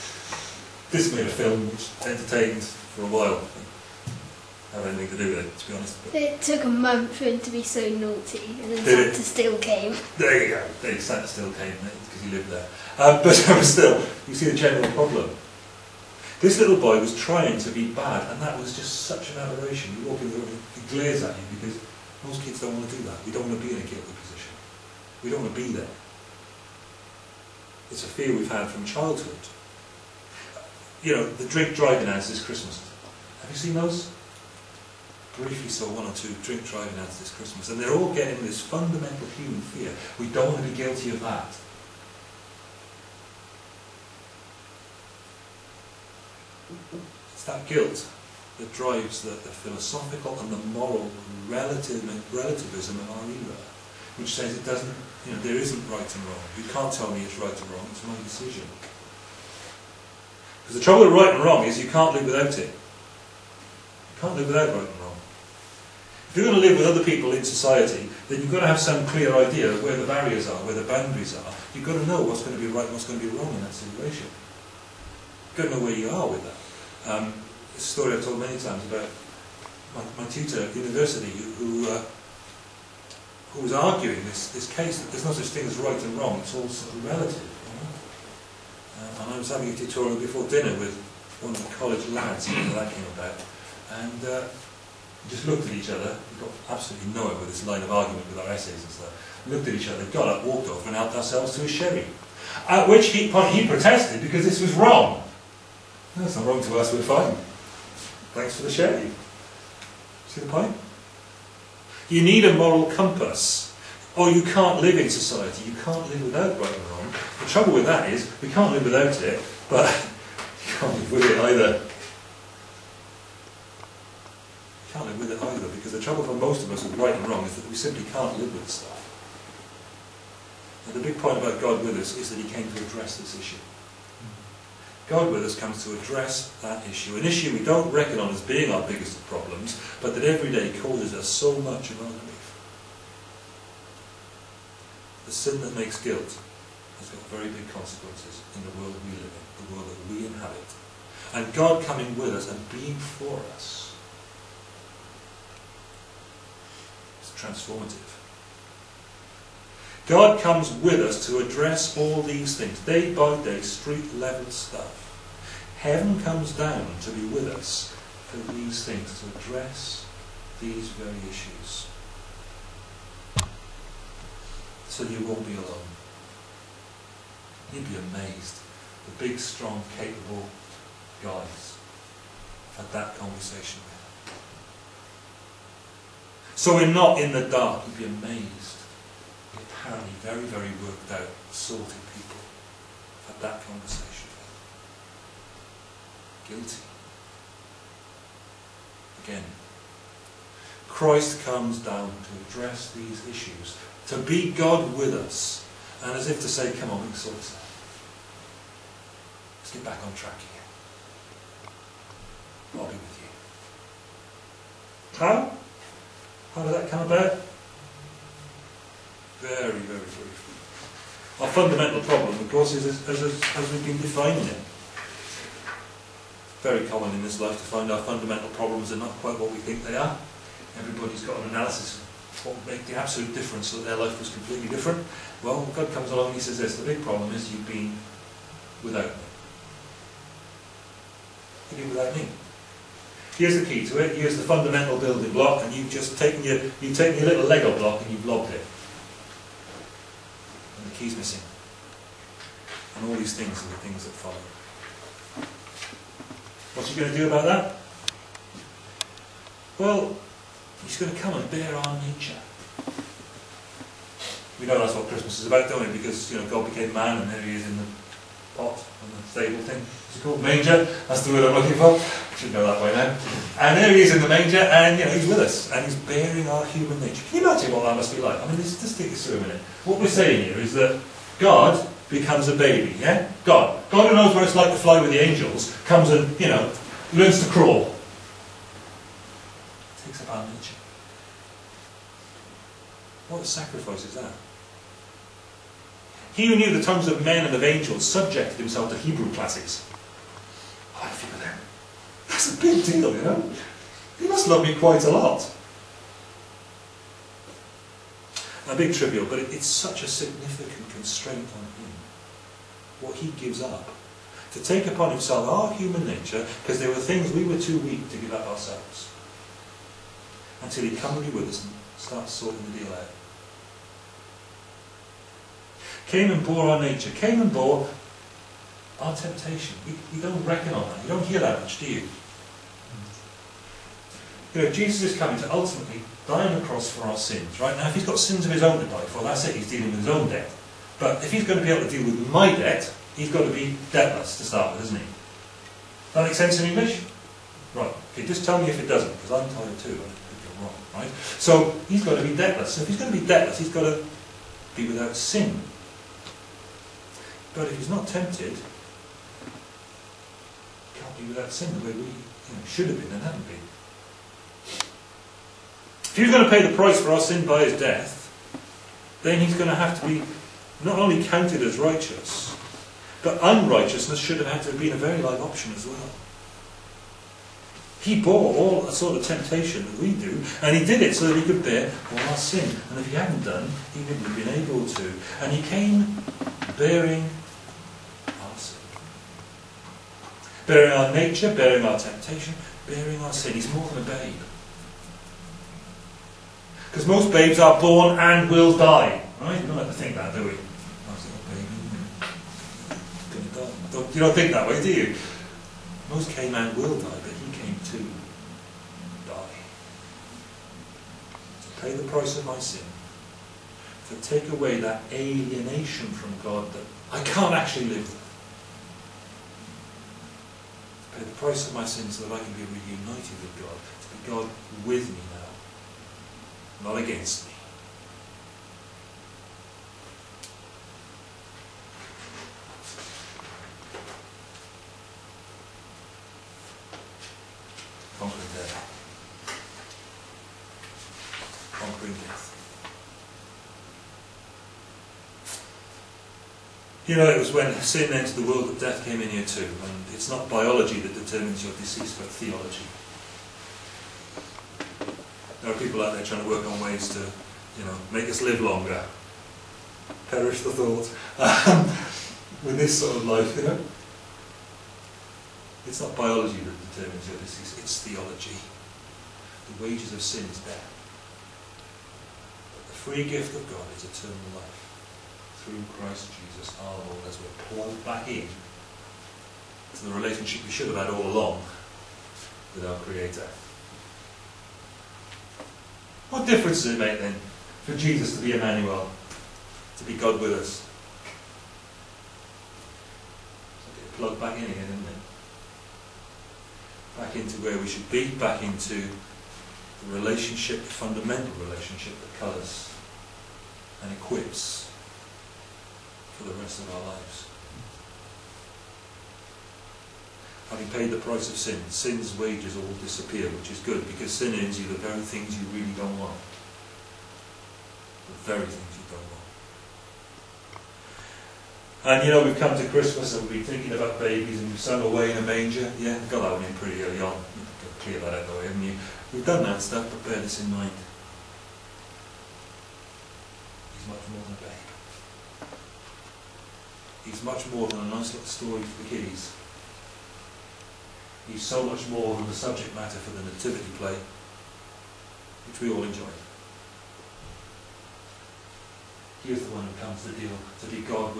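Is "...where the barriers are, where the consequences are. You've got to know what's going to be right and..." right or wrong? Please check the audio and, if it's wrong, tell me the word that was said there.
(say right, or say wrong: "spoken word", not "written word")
wrong: "boundaries", not "consequences".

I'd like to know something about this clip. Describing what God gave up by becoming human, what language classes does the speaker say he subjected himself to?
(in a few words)
Hebrew.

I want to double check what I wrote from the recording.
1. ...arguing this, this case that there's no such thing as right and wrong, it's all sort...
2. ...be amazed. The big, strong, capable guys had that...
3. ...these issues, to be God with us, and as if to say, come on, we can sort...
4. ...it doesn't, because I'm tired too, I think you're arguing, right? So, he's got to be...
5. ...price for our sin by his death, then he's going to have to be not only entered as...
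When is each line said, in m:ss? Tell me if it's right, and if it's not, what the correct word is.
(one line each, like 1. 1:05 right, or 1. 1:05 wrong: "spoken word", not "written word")
1. 1:23 right
2. 2:57 right
3. 3:22 right
4. 5:48 wrong: "wrong", not "arguing"
5. 6:06 wrong: "counted", not "entered".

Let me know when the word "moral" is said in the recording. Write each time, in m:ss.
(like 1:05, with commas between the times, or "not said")
0:50, 1:52.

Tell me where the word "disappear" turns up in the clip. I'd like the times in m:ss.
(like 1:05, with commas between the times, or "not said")
8:32.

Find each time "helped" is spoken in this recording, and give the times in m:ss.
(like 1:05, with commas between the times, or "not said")
1:40.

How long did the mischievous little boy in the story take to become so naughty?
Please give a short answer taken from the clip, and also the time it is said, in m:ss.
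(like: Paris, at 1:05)
a month, at 0:06.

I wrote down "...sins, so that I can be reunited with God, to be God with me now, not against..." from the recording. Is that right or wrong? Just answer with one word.
right.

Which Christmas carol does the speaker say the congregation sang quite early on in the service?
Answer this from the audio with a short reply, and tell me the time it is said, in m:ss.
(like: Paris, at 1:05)
Away in a Manger, at 8:45.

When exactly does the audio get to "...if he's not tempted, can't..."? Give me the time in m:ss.
5:57.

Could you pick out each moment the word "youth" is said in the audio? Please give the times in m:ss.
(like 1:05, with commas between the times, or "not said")
not said.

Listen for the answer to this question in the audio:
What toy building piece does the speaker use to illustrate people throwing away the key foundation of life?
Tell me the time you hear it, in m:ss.
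4:07.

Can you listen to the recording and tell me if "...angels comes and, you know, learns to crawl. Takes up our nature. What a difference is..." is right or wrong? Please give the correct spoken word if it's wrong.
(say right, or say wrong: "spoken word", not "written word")
wrong: "sacrifice", not "difference".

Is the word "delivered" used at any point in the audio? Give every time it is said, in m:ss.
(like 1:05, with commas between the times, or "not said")
not said.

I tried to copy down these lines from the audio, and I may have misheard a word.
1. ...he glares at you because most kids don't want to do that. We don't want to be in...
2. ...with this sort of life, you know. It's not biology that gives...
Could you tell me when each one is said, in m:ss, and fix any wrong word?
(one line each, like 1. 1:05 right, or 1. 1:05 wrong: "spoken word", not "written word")
1. 0:20 right
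2. 7:42 wrong: "determines", not "gives".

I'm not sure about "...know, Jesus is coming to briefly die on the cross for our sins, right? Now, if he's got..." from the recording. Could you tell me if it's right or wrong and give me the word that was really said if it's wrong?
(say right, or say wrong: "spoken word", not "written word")
wrong: "ultimately", not "briefly".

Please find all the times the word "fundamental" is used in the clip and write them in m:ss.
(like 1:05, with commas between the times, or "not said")
0:38, 3:41, 3:48, 4:04, 8:20.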